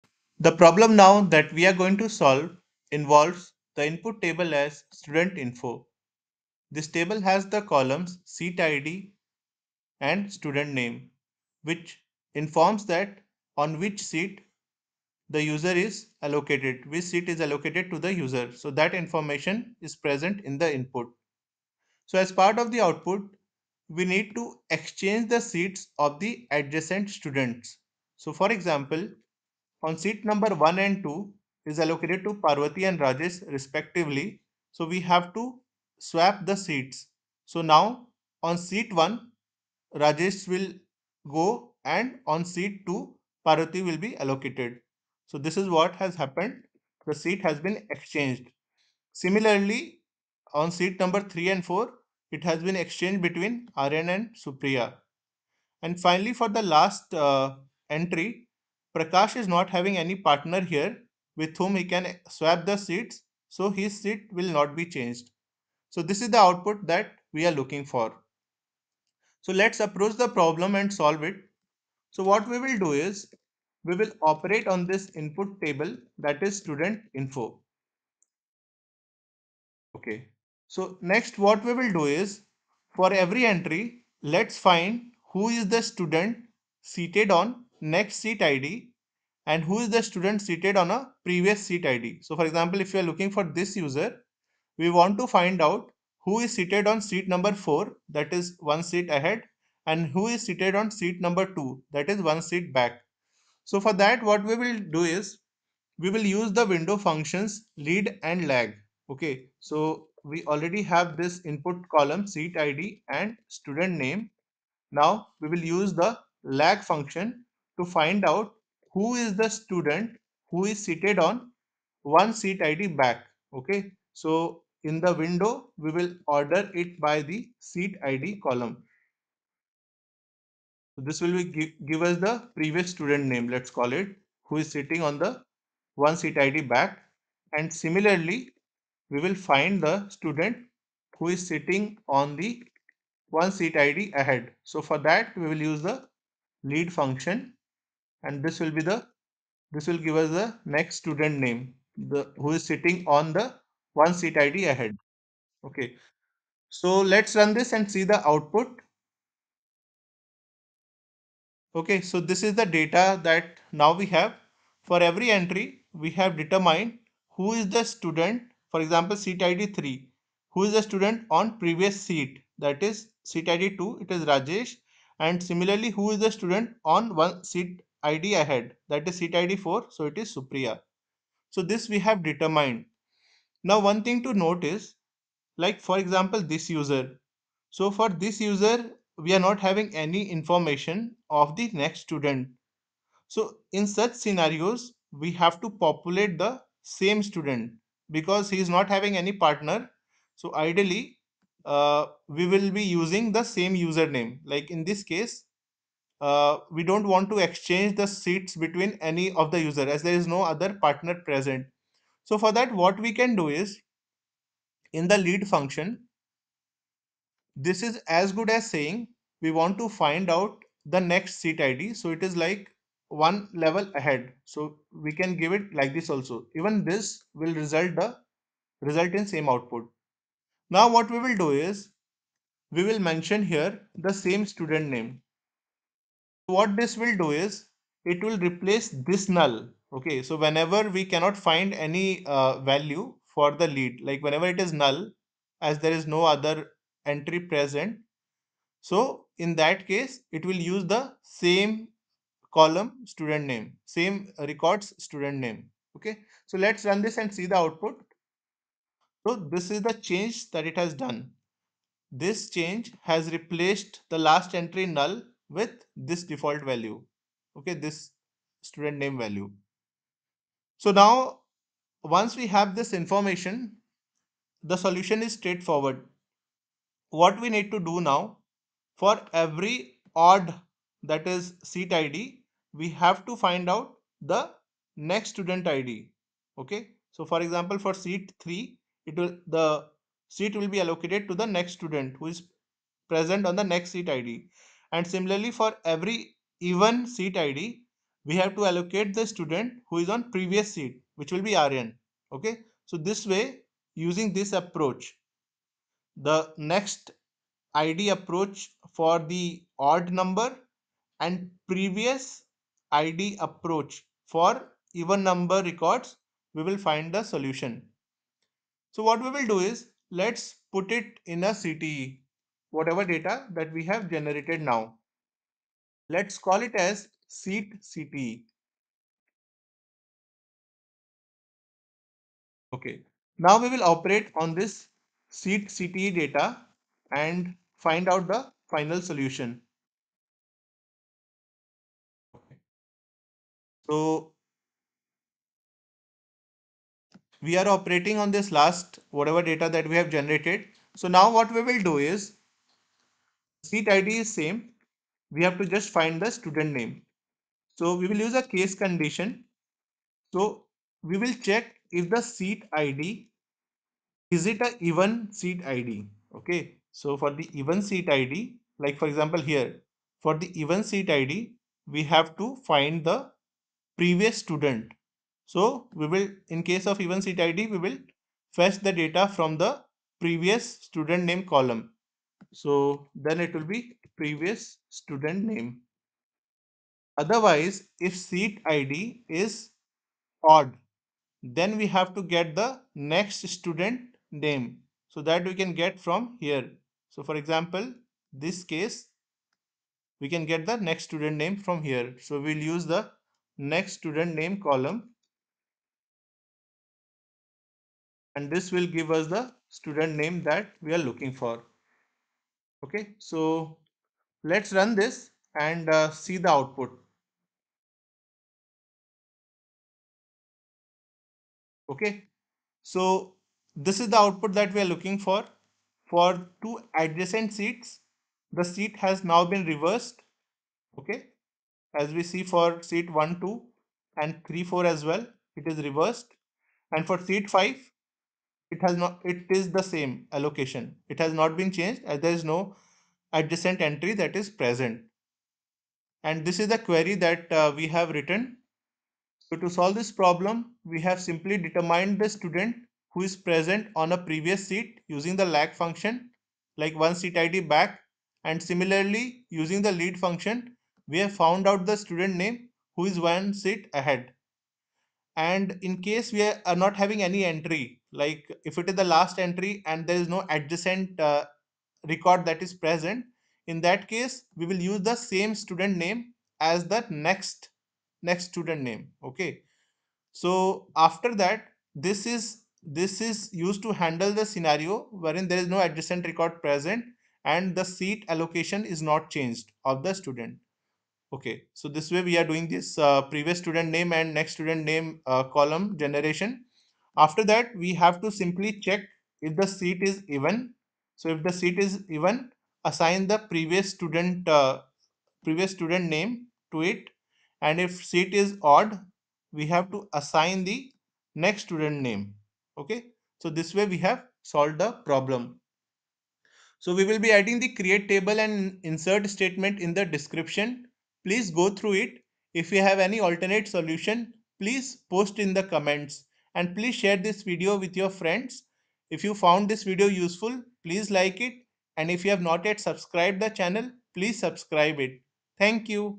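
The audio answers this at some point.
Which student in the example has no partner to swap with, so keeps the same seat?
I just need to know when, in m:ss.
0:58.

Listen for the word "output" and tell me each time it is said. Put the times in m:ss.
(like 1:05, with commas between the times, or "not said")
0:22, 1:06, 2:38, 3:49, 4:17, 6:56, 7:04.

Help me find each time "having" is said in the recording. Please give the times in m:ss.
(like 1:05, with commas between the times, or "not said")
0:59, 3:09, 3:18, 7:46.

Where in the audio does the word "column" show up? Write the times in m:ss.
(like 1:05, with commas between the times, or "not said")
0:07, 1:51, 2:08, 4:12, 6:21, 6:44, 8:15.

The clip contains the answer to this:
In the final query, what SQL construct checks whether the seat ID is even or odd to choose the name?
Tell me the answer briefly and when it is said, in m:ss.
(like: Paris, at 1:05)
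case condition, at 5:58.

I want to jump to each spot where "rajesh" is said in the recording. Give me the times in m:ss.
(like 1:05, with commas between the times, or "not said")
0:32, 0:39, 2:54.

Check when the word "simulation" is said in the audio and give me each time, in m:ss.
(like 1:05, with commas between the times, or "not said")
not said.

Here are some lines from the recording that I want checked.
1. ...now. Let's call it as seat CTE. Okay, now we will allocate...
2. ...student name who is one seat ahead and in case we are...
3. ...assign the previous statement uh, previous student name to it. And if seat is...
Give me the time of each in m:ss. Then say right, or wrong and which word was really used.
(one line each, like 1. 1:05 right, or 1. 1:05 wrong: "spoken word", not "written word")
1. 5:24 wrong: "operate", not "allocate"
2. 7:42 right
3. 8:22 wrong: "student", not "statement".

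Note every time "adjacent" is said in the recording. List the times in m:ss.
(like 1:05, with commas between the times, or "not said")
0:26, 7:06, 7:23, 7:50, 8:05.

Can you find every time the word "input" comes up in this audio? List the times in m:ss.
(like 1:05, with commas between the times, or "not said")
0:03, 0:20, 1:15, 1:51.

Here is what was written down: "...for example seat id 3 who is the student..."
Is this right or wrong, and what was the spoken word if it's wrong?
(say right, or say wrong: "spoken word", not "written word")
right.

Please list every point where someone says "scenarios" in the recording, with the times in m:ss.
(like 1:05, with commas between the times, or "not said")
3:14, 8:04.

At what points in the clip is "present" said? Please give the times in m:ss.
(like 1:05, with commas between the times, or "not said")
0:19, 3:31, 4:07, 4:53, 7:24, 7:33, 7:52, 8:06.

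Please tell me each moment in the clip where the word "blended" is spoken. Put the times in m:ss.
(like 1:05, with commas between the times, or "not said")
not said.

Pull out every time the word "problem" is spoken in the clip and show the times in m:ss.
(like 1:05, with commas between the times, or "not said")
0:00, 1:10, 7:30, 8:34.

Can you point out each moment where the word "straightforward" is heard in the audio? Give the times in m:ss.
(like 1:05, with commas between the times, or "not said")
4:35.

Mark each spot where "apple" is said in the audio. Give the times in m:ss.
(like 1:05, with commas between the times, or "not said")
not said.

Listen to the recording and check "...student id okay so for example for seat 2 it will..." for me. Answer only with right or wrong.
wrong.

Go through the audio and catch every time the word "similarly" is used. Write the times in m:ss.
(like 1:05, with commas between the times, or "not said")
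0:49, 2:17, 2:55, 4:55, 7:38.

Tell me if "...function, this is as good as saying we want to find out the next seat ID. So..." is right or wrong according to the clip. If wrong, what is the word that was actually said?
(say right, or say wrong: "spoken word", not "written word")
right.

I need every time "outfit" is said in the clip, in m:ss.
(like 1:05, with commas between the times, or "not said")
not said.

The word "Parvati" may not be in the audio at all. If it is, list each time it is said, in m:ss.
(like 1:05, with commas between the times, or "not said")
0:32, 0:43.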